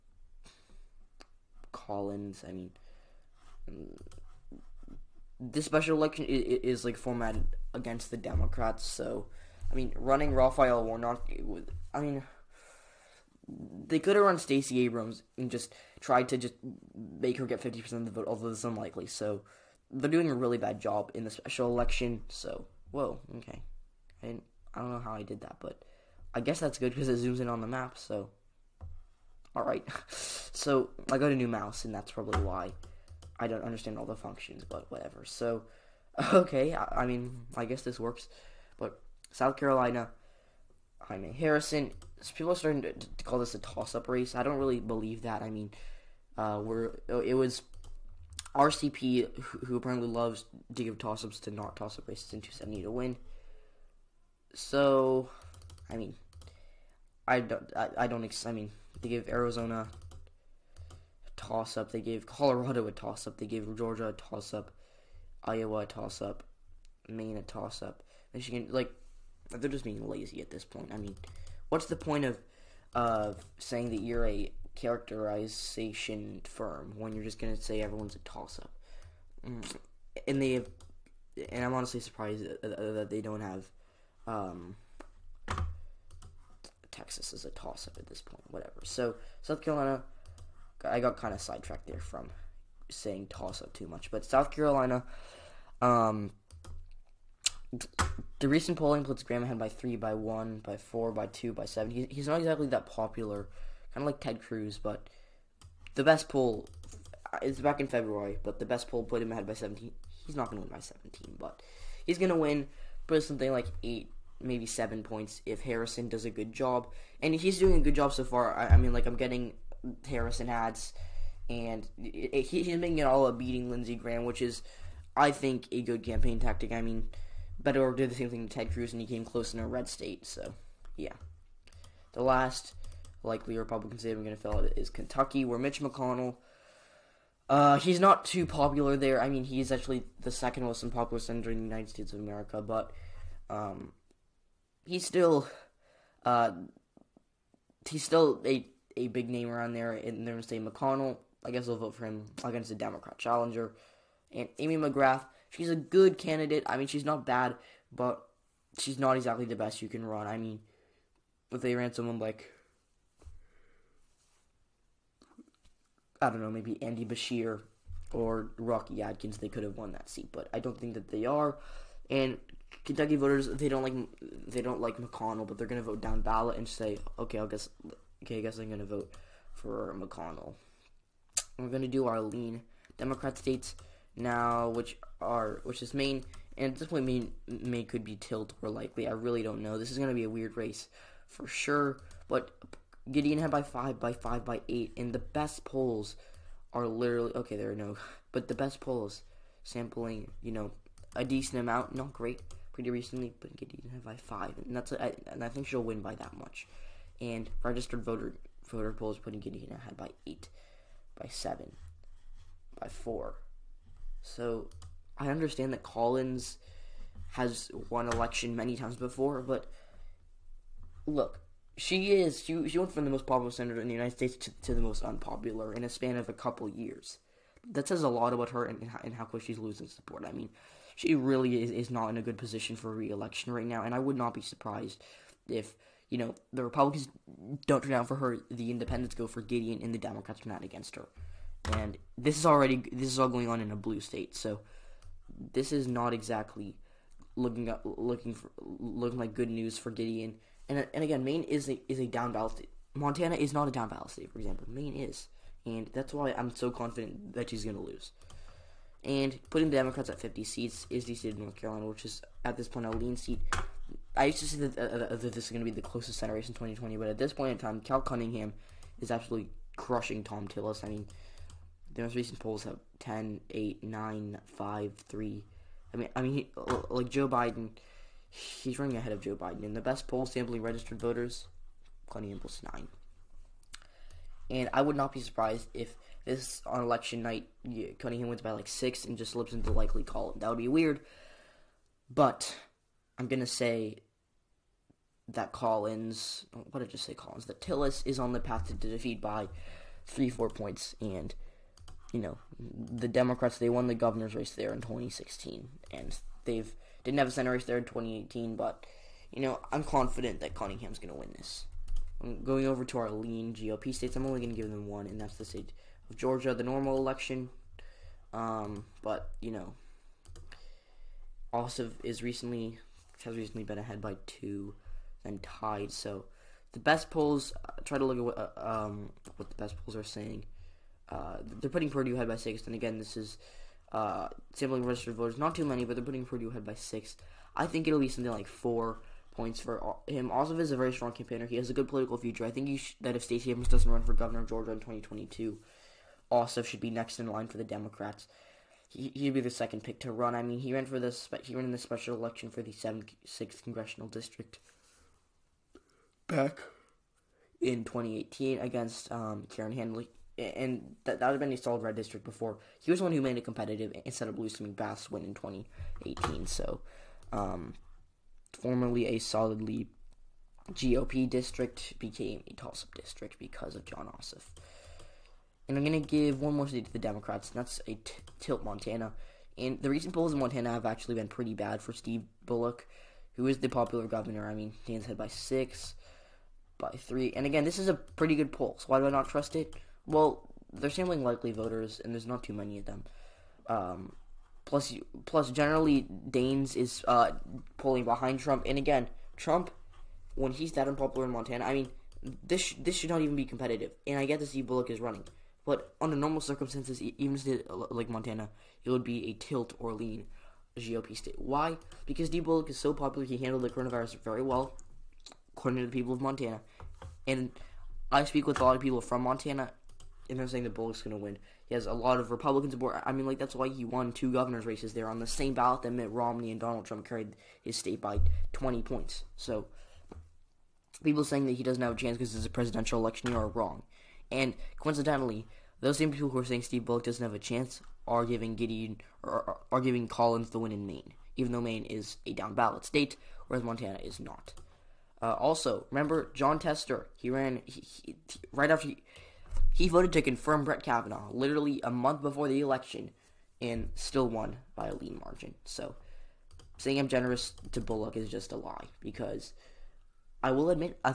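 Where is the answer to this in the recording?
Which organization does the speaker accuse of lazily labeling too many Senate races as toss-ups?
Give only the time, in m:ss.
0:48.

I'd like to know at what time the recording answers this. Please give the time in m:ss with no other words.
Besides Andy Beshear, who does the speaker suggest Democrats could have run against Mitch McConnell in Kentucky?
2:48.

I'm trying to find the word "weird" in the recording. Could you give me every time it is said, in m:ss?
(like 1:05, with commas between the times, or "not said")
3:10, 4:50.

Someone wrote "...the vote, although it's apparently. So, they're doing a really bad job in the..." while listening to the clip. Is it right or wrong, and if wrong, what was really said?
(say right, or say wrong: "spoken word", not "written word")
wrong: "unlikely", not "apparently".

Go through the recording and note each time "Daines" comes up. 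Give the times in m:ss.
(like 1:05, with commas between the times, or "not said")
6:24, 6:36.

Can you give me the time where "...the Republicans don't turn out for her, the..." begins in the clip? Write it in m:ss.
3:56.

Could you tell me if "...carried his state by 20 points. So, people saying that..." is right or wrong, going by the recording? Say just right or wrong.
right.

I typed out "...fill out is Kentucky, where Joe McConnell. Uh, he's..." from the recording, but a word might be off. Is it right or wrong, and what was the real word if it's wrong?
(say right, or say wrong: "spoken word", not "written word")
wrong: "Mitch", not "Joe".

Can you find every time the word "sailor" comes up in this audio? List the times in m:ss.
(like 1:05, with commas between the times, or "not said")
not said.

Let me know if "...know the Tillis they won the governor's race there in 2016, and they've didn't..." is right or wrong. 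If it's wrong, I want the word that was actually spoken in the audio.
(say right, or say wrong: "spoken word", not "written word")
wrong: "Democrats", not "Tillis".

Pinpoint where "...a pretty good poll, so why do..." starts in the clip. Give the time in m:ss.
6:27.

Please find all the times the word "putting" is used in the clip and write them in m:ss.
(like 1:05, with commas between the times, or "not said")
3:29, 4:19, 5:31, 5:36.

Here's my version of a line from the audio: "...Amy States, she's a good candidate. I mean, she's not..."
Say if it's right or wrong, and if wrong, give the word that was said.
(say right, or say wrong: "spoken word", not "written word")
wrong: "McGrath", not "States".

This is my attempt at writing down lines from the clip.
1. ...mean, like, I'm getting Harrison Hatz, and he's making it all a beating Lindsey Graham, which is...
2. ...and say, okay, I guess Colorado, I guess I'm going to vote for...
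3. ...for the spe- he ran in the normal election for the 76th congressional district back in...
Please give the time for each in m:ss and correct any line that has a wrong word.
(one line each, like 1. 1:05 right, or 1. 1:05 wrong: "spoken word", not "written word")
1. 1:58 right
2. 2:56 wrong: "Okay", not "Colorado"
3. 5:50 wrong: "special", not "normal".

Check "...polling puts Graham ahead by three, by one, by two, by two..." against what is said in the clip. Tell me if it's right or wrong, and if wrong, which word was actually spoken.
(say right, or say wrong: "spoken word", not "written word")
wrong: "four", not "two".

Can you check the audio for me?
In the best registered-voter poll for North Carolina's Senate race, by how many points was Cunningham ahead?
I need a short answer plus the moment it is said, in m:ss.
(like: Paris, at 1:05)
9, at 4:42.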